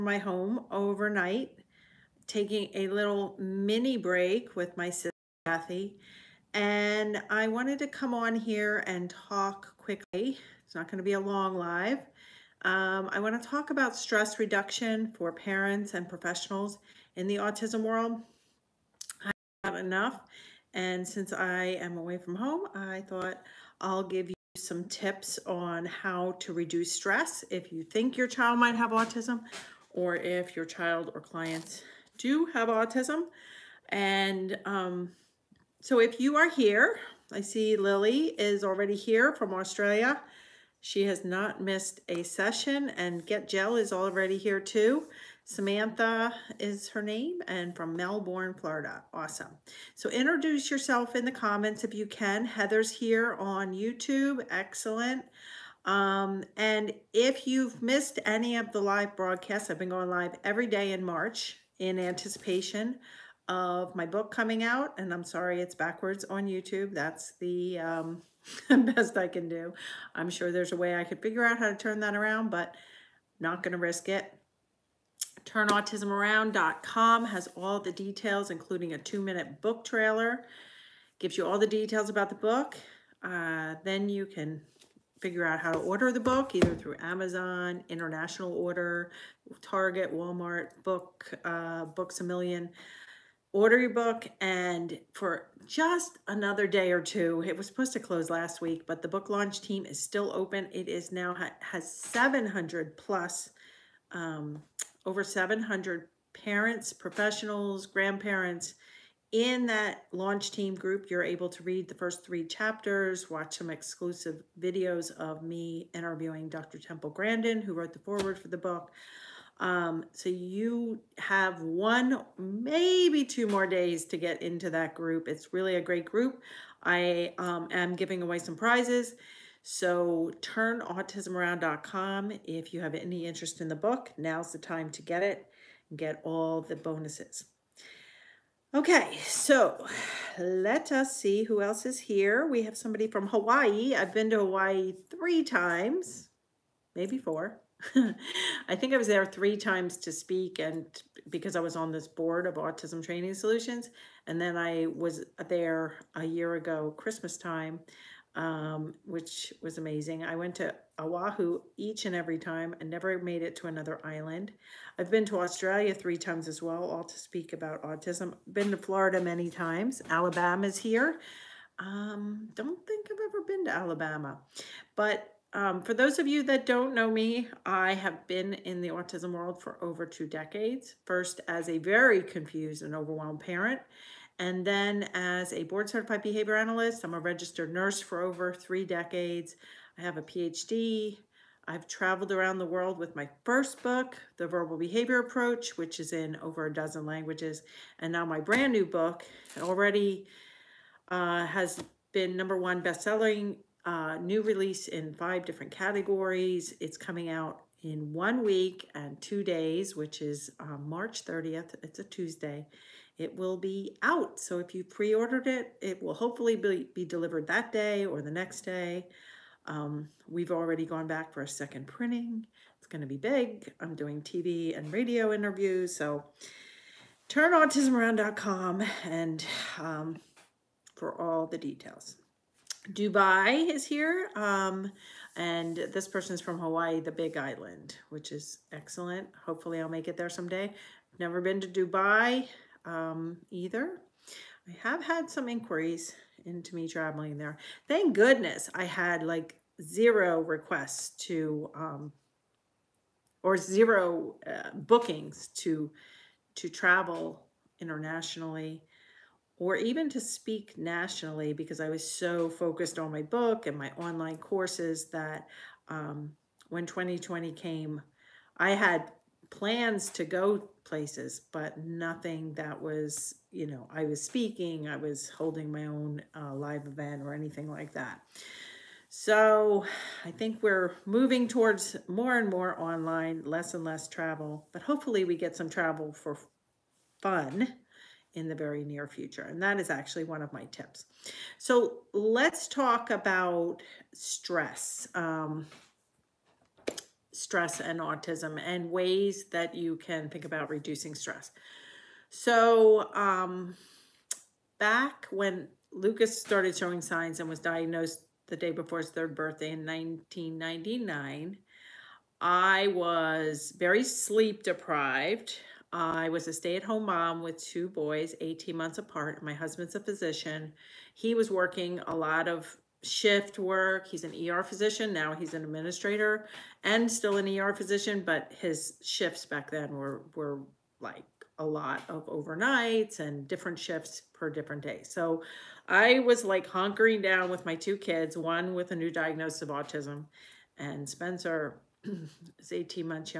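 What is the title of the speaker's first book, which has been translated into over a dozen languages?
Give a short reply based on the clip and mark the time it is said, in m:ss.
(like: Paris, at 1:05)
The Verbal Behavior Approach, at 3:14.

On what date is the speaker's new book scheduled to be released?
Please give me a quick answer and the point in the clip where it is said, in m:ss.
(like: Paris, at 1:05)
March 30th, at 3:30.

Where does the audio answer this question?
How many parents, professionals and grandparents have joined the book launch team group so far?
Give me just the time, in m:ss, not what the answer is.
1:45.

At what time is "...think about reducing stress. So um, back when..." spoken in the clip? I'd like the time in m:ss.
5:00.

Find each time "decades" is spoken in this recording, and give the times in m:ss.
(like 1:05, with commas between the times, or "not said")
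3:00, 3:08.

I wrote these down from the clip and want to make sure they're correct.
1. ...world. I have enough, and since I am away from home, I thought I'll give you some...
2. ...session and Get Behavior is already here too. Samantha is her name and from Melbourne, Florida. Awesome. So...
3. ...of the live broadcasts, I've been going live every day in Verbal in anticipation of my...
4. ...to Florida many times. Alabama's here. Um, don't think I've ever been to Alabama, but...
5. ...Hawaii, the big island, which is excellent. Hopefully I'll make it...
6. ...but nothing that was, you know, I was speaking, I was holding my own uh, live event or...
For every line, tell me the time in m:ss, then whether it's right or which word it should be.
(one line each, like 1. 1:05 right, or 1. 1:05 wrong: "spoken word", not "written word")
1. 0:17 right
2. 0:42 wrong: "Gel", not "Behavior"
3. 0:58 wrong: "March", not "Verbal"
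4. 2:48 right
5. 3:56 right
6. 4:31 right.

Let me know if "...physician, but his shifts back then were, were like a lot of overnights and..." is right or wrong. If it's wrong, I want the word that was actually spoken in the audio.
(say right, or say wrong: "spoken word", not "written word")
right.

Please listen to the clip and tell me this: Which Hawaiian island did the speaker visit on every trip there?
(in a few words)
Oahu.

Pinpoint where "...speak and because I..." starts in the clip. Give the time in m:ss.
2:30.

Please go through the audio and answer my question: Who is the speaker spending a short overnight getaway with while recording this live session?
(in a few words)
Kathy.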